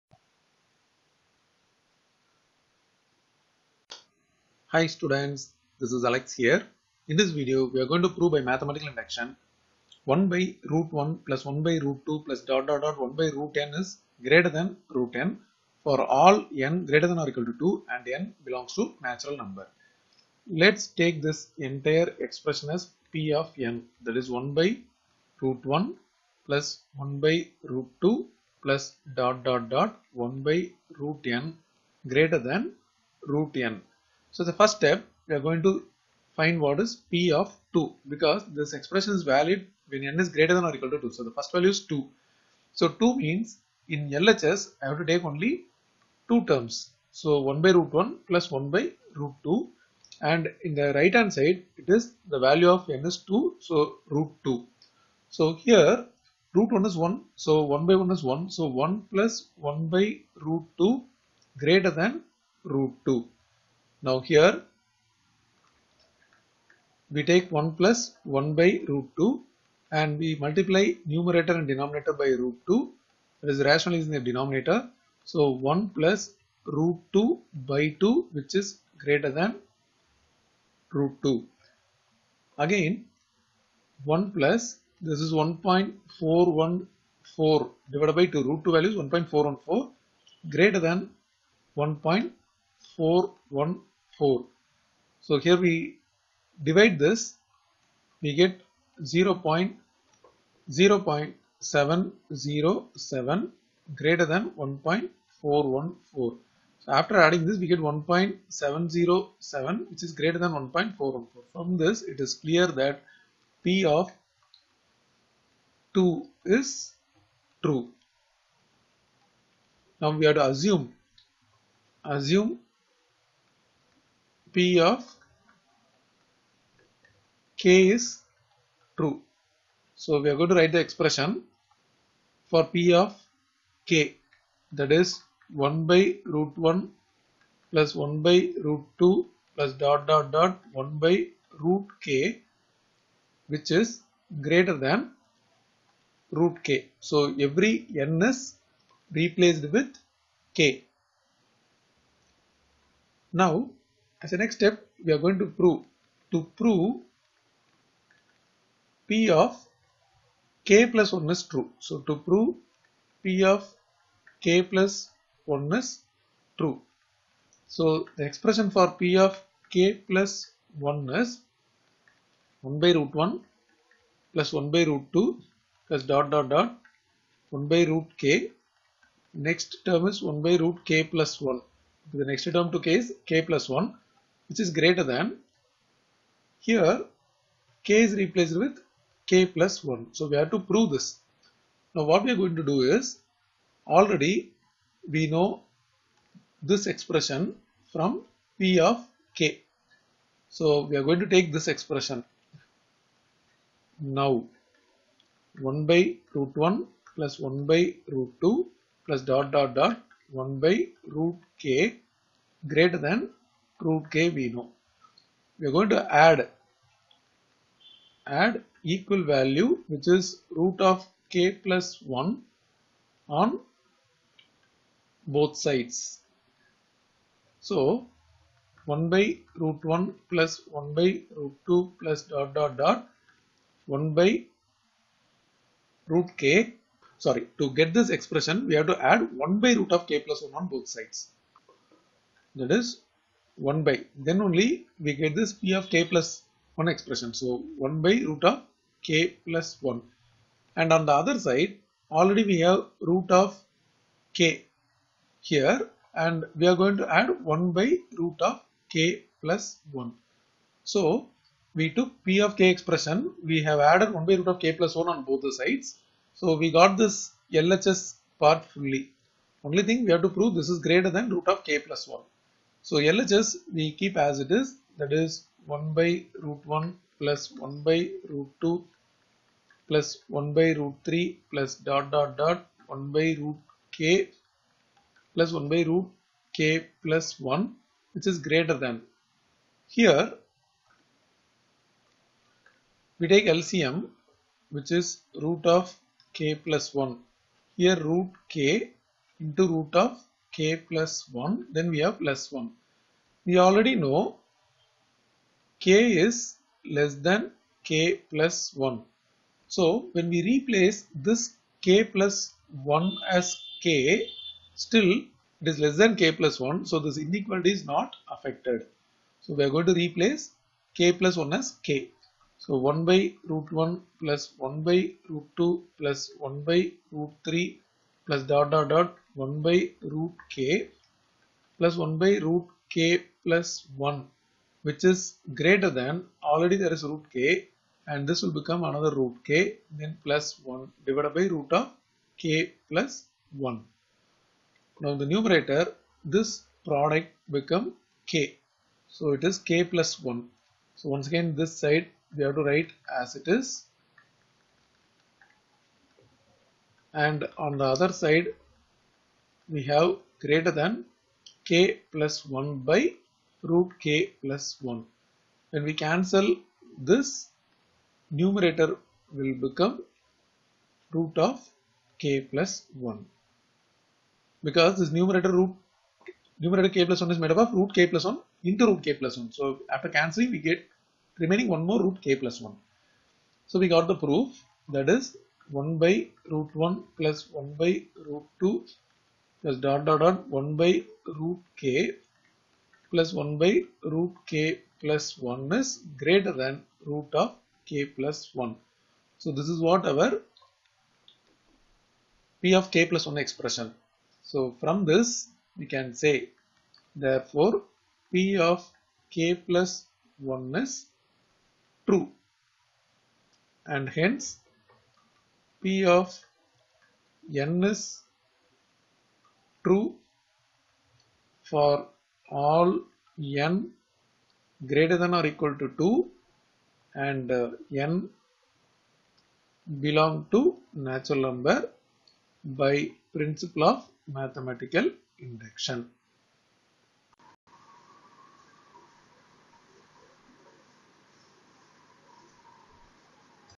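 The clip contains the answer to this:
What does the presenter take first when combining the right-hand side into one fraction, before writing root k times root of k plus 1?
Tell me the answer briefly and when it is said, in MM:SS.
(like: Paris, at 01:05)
LCM, at 04:53.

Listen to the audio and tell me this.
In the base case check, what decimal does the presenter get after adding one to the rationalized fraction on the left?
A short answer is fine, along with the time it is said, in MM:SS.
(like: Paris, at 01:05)
1.707, at 01:47.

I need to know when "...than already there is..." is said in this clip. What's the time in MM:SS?
05:35.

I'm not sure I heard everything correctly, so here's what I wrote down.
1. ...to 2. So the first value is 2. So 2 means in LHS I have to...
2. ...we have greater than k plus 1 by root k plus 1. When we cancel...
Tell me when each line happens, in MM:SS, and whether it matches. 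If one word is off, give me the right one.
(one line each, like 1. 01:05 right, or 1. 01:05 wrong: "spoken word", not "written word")
1. 00:40 right
2. 05:59 right.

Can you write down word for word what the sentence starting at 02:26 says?
So every n is replaced with K.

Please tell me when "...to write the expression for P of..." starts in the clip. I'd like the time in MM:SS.
02:10.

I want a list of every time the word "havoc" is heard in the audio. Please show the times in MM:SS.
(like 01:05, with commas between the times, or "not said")
not said.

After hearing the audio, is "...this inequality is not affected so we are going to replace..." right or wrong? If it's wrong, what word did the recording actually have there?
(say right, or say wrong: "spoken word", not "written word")
right.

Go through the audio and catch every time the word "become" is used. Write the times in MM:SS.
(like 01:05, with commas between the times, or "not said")
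05:38, 05:47, 06:09.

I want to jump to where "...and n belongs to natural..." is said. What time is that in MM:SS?
00:17.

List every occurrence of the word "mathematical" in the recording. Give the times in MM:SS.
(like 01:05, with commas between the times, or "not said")
00:08, 07:14.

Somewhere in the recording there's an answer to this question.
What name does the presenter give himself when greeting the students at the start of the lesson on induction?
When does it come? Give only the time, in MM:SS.
00:06.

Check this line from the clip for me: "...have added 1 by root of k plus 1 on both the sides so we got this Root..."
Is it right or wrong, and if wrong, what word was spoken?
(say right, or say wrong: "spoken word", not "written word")
wrong: "LHS", not "Root".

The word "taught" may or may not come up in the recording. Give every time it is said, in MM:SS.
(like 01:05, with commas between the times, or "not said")
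not said.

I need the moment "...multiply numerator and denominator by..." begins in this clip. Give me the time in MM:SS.
01:10.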